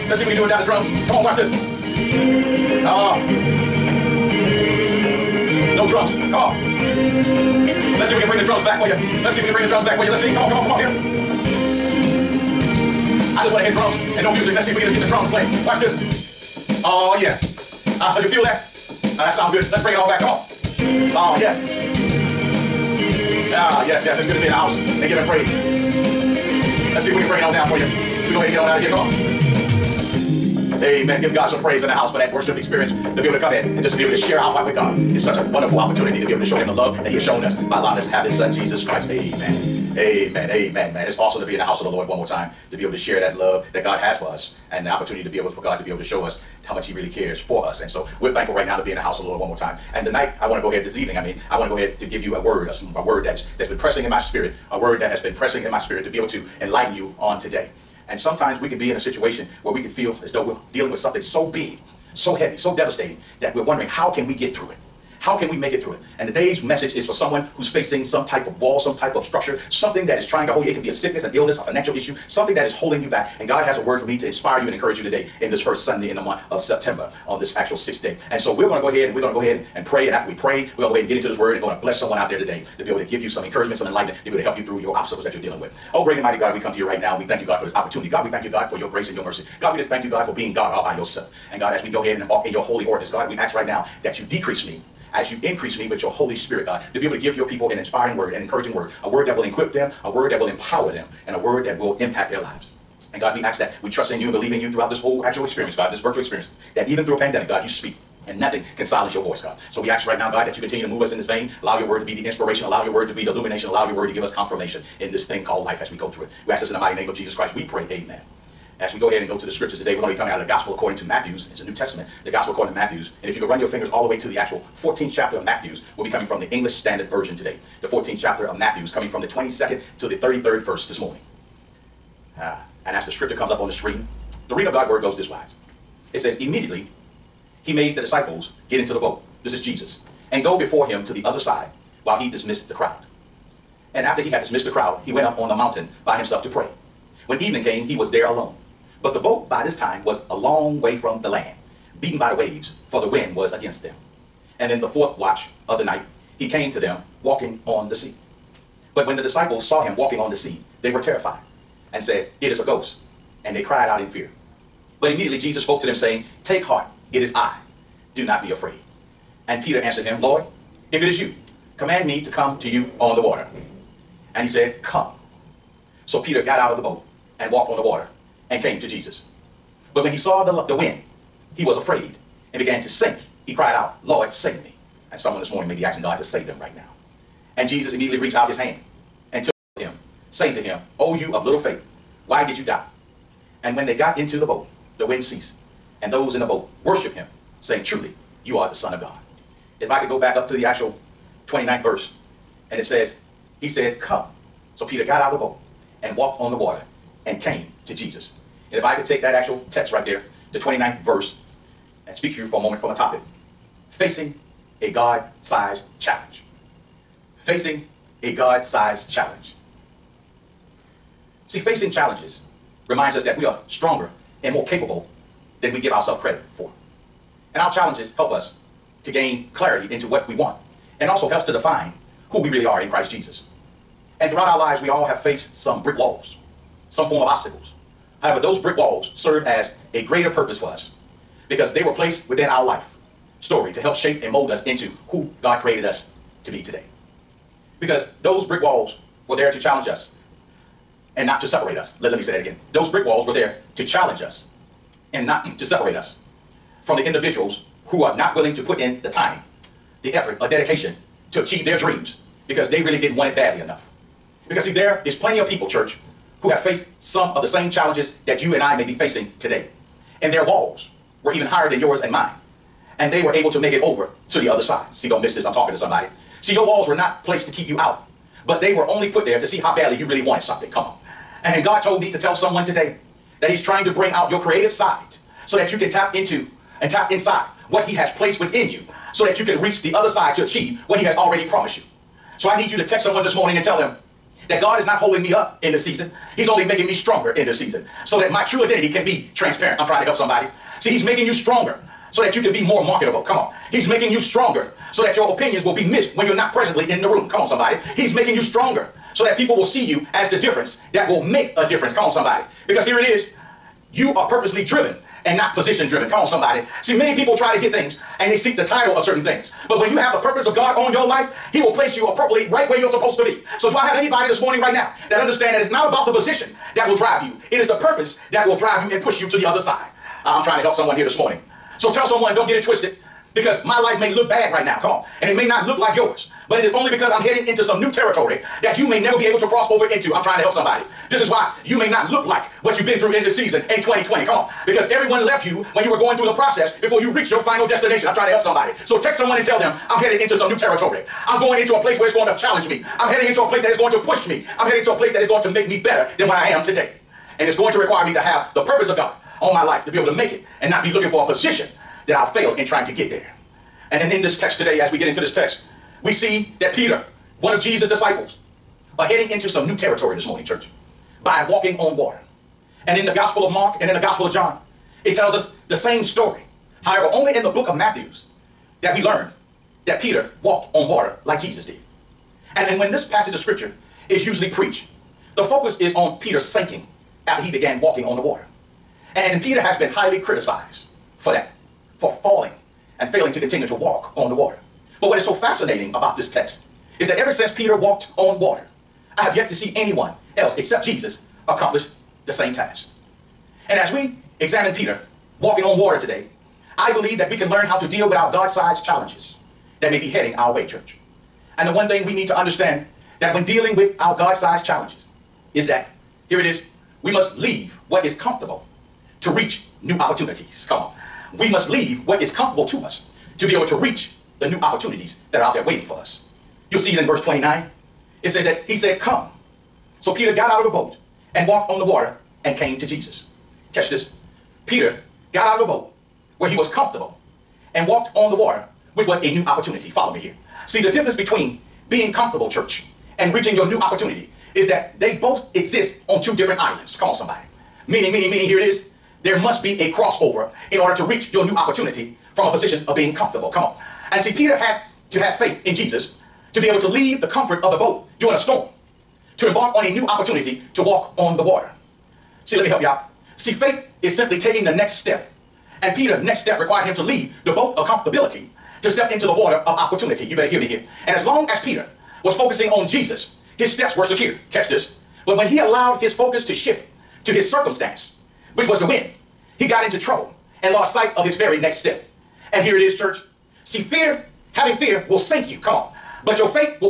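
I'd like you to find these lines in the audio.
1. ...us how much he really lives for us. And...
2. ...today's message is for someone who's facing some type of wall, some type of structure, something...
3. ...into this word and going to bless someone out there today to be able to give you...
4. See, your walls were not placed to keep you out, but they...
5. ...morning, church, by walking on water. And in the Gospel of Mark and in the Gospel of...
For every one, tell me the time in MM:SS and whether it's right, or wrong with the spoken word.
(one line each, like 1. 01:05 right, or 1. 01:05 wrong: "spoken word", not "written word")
1. 00:46 wrong: "cares", not "lives"
2. 01:06 right
3. 01:21 right
4. 04:36 right
5. 06:10 right.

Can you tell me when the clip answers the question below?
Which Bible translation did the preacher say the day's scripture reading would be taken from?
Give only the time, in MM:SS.
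02:06.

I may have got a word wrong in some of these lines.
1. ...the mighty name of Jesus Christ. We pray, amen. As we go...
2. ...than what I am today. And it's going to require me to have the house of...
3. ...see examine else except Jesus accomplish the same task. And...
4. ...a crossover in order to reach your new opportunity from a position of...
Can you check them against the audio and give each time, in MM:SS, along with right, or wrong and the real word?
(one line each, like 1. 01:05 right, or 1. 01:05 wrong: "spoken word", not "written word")
1. 01:56 right
2. 05:56 wrong: "purpose", not "house"
3. 06:39 wrong: "anyone", not "examine"
4. 07:29 right.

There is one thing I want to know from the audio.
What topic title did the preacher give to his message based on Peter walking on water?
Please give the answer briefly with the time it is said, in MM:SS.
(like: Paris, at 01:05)
Facing a God-sized challenge, at 03:33.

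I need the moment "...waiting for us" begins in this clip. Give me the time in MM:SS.
07:05.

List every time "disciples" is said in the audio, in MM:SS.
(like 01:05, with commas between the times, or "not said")
02:17, 02:39, 06:07.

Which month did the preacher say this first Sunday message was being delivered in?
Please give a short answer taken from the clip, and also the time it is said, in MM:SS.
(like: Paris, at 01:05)
September, at 01:16.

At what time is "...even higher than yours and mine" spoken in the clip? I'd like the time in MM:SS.
04:31.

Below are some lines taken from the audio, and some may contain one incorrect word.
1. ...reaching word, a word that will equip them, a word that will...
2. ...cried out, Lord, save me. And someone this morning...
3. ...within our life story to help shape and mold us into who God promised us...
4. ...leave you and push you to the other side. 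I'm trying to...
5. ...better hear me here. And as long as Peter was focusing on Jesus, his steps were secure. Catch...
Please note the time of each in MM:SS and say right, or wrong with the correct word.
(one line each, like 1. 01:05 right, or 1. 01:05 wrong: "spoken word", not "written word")
1. 01:38 wrong: "encouraging", not "reaching"
2. 03:03 right
3. 04:02 wrong: "created", not "promised"
4. 05:28 wrong: "drive", not "leave"
5. 07:50 right.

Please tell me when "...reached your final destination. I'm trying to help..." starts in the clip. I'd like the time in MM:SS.
05:47.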